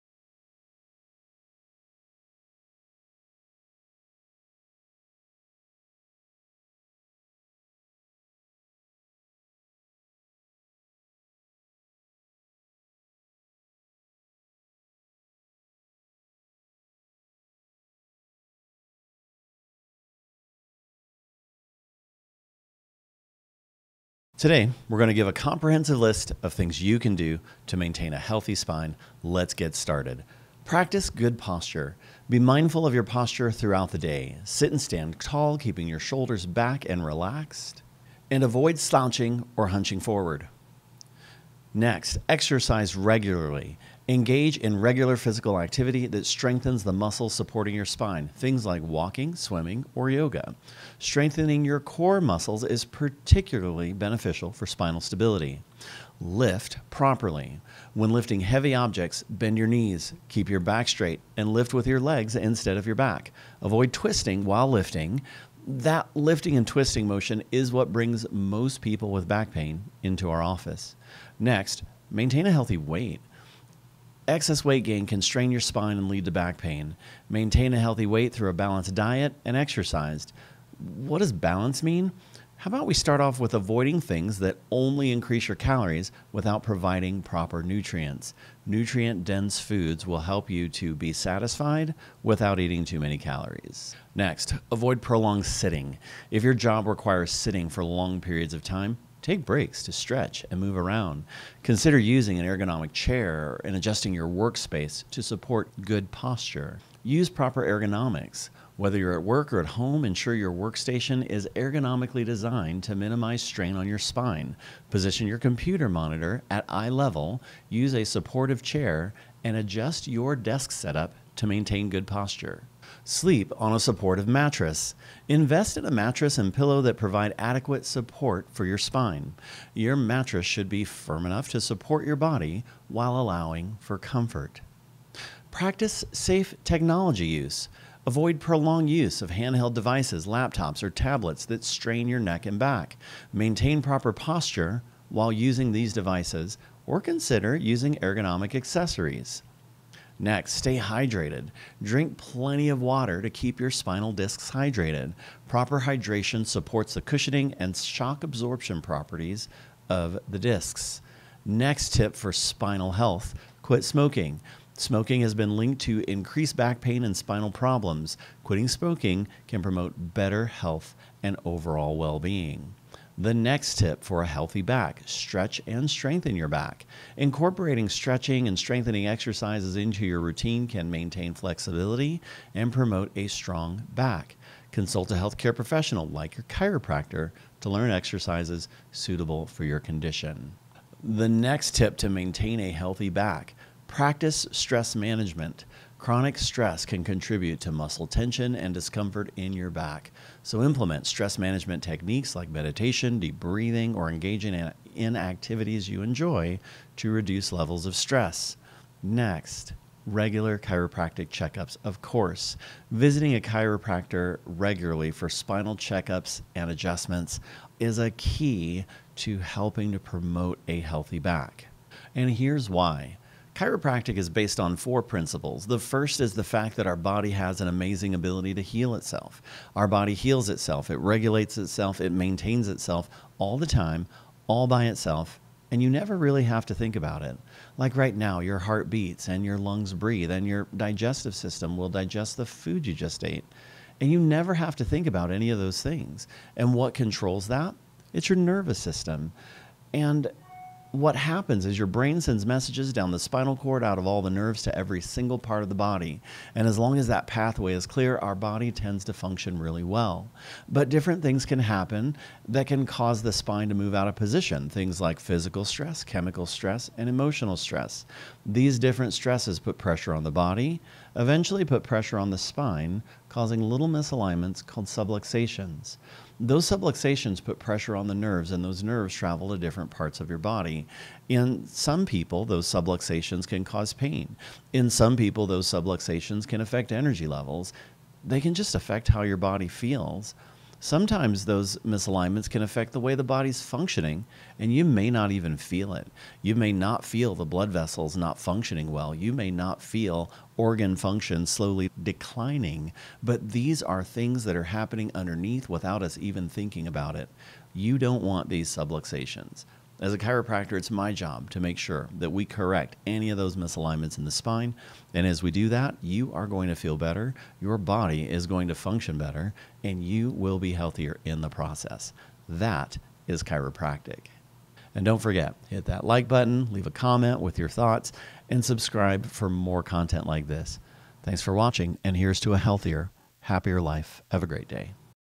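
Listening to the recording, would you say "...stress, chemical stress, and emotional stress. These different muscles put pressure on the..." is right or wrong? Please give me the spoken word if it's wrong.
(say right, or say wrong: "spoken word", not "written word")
wrong: "stresses", not "muscles".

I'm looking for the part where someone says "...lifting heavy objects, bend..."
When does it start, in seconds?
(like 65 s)
58 s.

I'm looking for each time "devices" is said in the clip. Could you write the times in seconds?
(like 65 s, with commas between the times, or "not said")
139 s, 145 s.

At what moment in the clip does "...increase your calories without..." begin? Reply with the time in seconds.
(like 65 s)
85 s.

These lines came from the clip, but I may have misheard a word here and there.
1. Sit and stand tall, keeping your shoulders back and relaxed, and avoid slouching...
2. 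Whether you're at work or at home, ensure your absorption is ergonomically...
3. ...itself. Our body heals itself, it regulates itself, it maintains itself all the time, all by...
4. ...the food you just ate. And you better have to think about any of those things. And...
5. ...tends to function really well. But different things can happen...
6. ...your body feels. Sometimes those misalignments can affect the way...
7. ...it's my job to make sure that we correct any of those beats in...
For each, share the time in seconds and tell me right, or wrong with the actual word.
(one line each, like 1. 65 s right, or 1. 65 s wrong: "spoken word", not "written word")
1. 34 s right
2. 108 s wrong: "workstation", not "absorption"
3. 228 s right
4. 242 s wrong: "never", not "better"
5. 258 s right
6. 289 s right
7. 310 s wrong: "misalignments", not "beats".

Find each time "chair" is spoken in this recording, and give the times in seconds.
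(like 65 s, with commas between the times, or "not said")
102 s, 118 s.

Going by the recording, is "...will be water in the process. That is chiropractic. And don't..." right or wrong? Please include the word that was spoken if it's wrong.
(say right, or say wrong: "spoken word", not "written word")
wrong: "healthier", not "water".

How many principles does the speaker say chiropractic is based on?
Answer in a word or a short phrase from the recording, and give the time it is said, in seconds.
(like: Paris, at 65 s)
4, at 224 s.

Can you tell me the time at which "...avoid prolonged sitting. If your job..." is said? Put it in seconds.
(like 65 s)
94 s.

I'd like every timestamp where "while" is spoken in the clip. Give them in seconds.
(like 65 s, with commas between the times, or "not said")
64 s, 132 s, 145 s.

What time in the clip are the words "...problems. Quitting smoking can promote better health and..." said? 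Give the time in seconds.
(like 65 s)
167 s.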